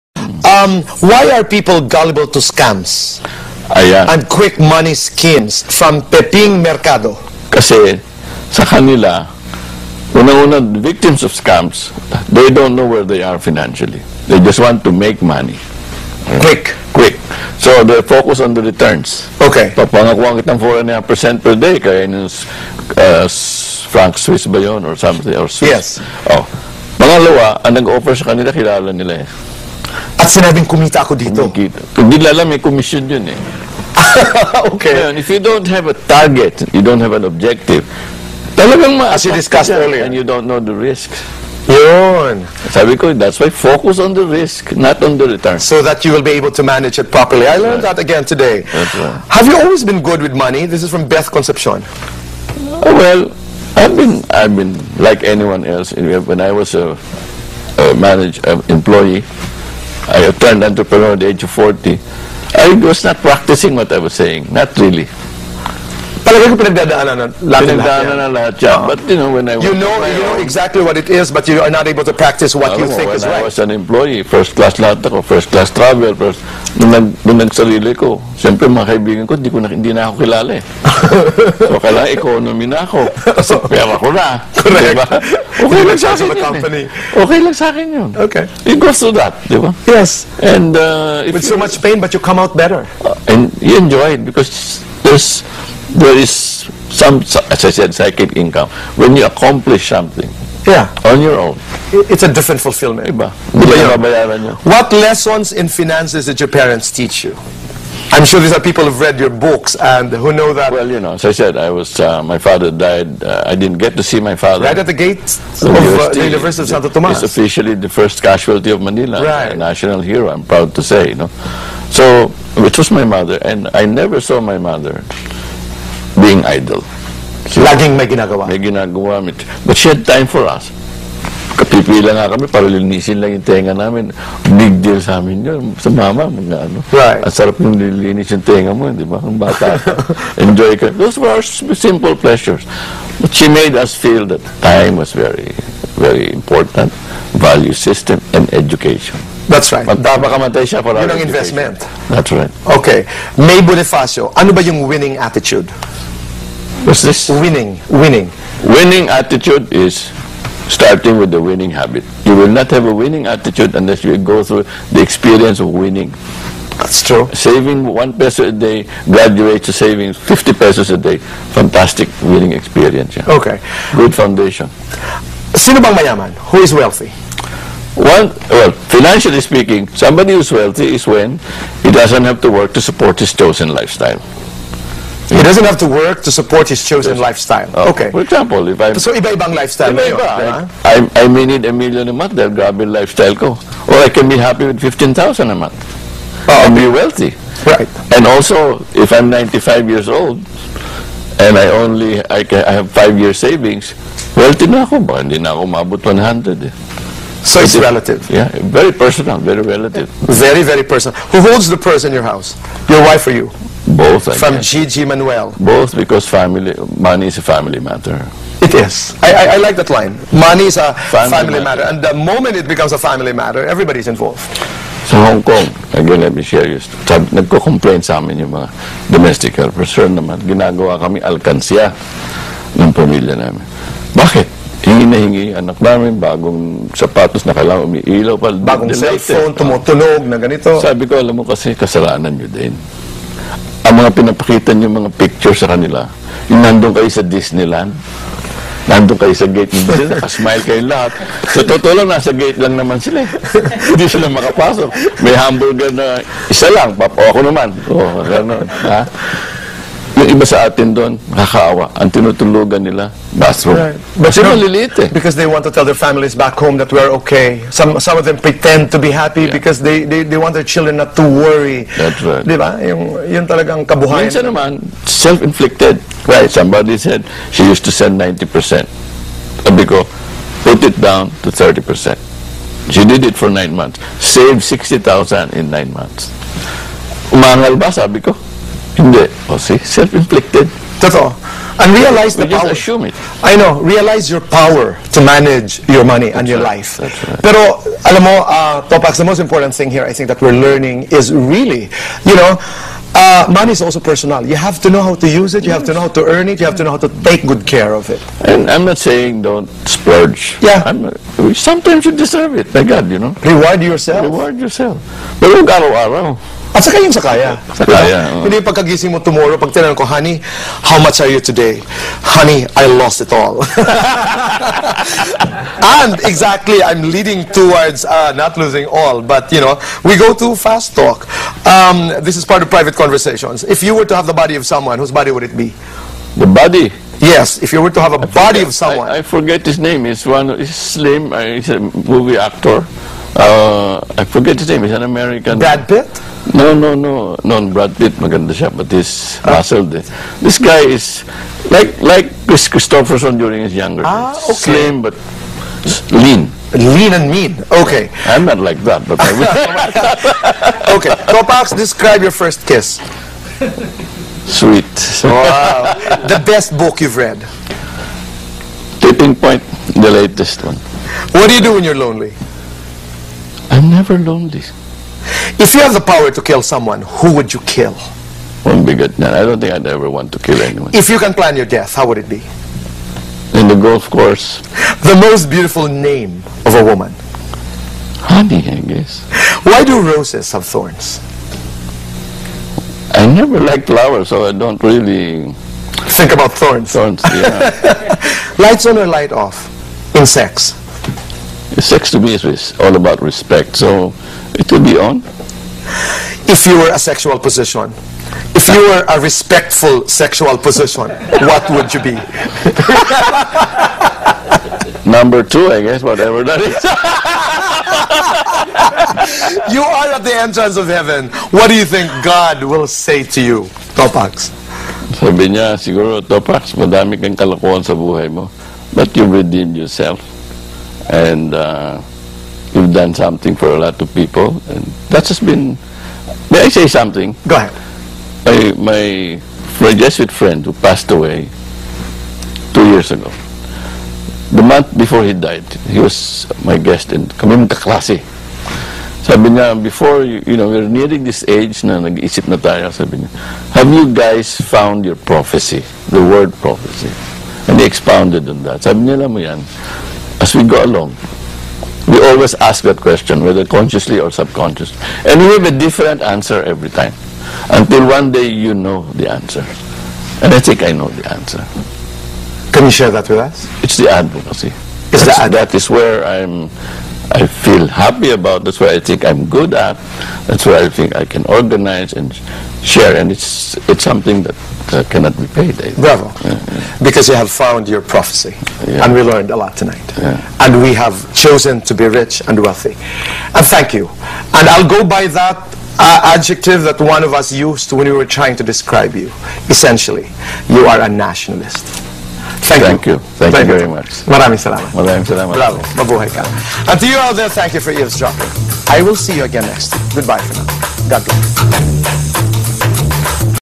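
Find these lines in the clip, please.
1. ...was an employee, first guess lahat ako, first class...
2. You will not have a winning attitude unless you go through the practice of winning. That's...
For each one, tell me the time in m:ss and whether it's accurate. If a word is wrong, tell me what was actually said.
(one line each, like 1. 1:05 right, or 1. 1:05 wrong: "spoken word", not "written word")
1. 1:13 wrong: "class", not "guess"
2. 2:42 wrong: "experience", not "practice".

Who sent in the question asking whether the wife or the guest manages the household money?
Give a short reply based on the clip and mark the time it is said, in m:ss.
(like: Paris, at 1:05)
G.G. Manuel, at 3:34.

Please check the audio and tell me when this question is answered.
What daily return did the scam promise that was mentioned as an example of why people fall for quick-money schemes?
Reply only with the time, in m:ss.
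0:20.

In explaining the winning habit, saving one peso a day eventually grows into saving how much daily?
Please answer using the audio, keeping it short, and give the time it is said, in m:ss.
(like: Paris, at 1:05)
50 pesos, at 2:50.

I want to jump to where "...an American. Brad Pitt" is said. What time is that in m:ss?
5:44.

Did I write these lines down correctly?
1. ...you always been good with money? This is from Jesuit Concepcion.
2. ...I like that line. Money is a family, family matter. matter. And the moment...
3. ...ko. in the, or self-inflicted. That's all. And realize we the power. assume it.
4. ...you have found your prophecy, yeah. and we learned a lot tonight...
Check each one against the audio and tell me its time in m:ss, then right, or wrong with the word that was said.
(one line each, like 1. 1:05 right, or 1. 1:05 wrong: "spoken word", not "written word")
1. 0:49 wrong: "Beth", not "Jesuit"
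2. 3:39 right
3. 4:48 right
4. 8:07 right.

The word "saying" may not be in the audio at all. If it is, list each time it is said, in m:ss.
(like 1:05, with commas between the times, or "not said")
1:04, 5:08.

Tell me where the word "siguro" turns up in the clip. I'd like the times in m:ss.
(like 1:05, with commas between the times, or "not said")
7:05.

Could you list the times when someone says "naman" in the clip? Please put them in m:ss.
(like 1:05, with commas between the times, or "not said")
3:50, 4:12, 4:17, 4:34.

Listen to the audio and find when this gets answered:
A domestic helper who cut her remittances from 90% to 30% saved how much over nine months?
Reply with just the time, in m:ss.
4:44.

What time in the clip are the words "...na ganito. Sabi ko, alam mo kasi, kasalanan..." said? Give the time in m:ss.
4:00.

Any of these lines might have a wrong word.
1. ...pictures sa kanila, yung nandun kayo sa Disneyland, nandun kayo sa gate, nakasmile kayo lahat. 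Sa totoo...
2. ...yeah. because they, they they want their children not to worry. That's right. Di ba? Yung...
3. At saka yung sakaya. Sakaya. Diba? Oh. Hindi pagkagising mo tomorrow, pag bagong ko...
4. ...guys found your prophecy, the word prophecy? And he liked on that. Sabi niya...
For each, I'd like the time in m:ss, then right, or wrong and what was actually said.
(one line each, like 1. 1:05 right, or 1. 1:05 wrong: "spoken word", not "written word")
1. 4:05 right
2. 4:29 right
3. 5:16 wrong: "tinanong", not "bagong"
4. 7:34 wrong: "expounded", not "liked".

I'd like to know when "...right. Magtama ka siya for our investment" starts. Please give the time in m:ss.
2:29.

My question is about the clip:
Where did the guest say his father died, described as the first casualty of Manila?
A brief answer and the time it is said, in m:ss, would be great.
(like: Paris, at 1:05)
University of Santo Tomas, at 1:56.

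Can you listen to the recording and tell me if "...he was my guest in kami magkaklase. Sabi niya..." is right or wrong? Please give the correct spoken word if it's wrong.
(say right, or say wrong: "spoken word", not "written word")
right.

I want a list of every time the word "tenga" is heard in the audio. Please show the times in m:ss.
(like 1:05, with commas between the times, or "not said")
2:13, 2:18.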